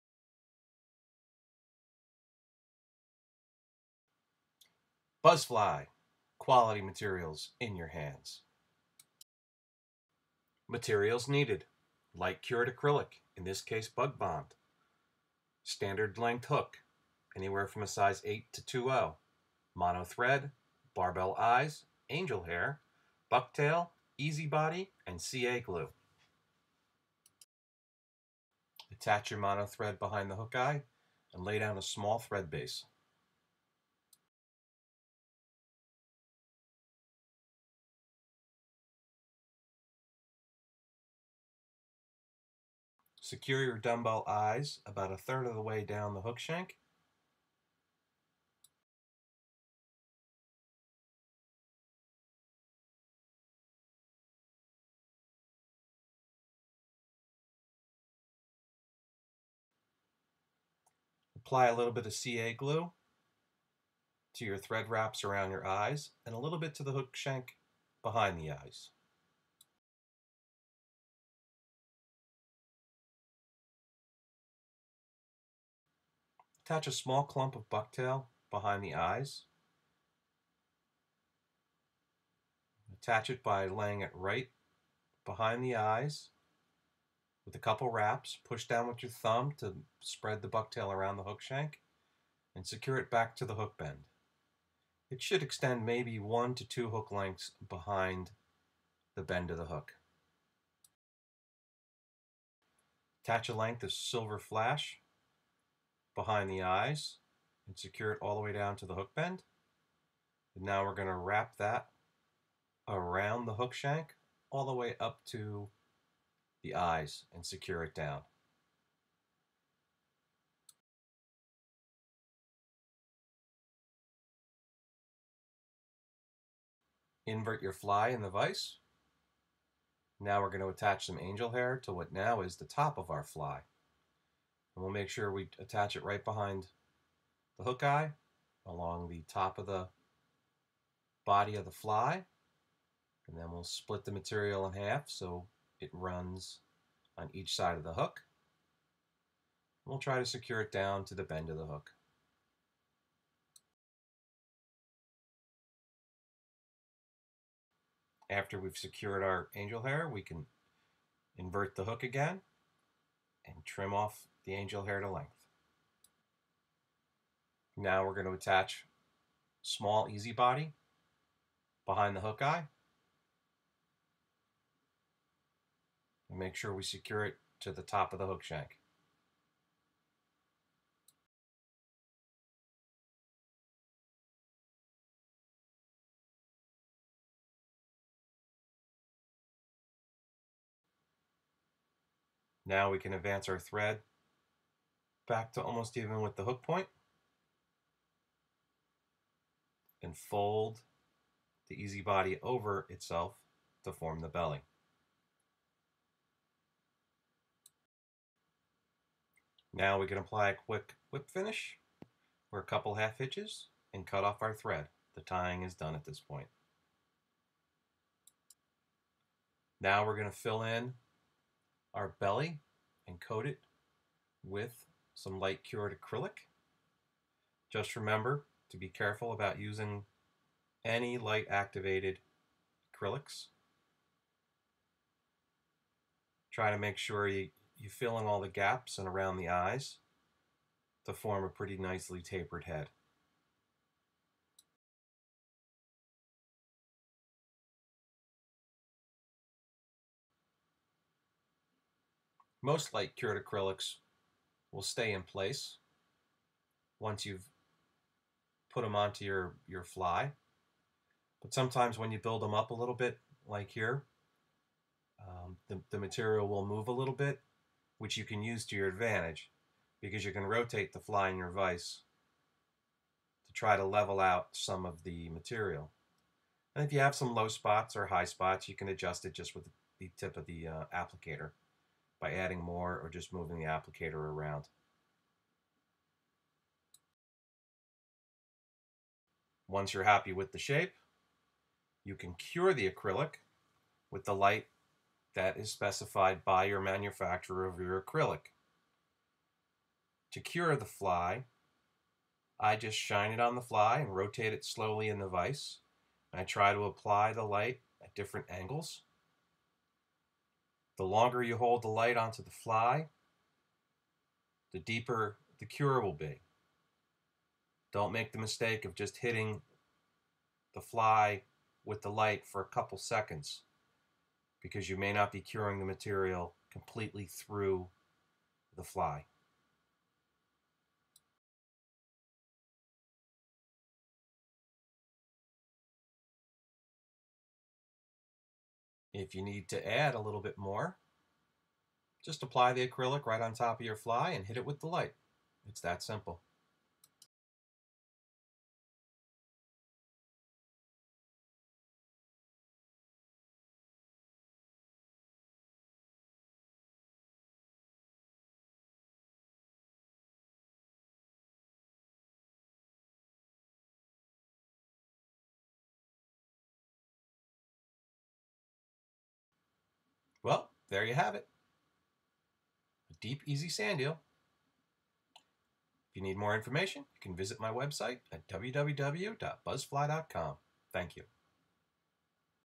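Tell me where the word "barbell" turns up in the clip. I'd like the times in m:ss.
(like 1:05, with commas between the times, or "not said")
0:20.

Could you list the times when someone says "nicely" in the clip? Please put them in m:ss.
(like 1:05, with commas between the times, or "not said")
4:01.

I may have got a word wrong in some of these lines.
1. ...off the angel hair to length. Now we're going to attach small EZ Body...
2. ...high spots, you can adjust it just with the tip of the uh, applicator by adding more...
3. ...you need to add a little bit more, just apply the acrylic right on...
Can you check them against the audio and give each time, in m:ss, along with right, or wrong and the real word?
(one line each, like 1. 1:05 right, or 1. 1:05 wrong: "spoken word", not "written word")
1. 2:43 right
2. 4:38 right
3. 5:39 right.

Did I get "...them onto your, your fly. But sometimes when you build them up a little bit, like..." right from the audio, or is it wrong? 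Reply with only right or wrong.
right.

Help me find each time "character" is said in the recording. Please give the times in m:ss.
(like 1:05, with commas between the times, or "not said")
not said.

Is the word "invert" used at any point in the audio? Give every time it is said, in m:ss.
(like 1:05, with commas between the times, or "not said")
2:07, 2:41.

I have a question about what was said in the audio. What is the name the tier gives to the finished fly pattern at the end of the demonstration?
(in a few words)
deep EZ sand eel.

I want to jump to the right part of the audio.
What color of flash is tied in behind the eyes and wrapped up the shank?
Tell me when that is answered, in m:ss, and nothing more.
1:43.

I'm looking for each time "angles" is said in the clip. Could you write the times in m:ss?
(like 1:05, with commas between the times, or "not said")
5:08.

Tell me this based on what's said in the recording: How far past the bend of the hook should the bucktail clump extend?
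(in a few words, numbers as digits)
1 to 2 hook lengths.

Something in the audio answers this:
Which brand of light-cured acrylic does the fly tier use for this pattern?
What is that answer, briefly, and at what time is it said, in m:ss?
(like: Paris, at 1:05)
Bug Bond, at 0:13.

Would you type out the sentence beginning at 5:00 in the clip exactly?
To cure the fly, I just shine it on the fly and rotate it slowly in the vise.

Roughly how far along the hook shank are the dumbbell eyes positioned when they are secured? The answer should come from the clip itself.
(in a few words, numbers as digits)
a third.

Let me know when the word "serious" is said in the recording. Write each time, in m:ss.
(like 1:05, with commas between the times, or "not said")
not said.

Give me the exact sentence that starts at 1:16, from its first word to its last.
Attach a small clump of bucktail behind the eyes.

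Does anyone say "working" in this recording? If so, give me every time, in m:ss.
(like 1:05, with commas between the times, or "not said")
not said.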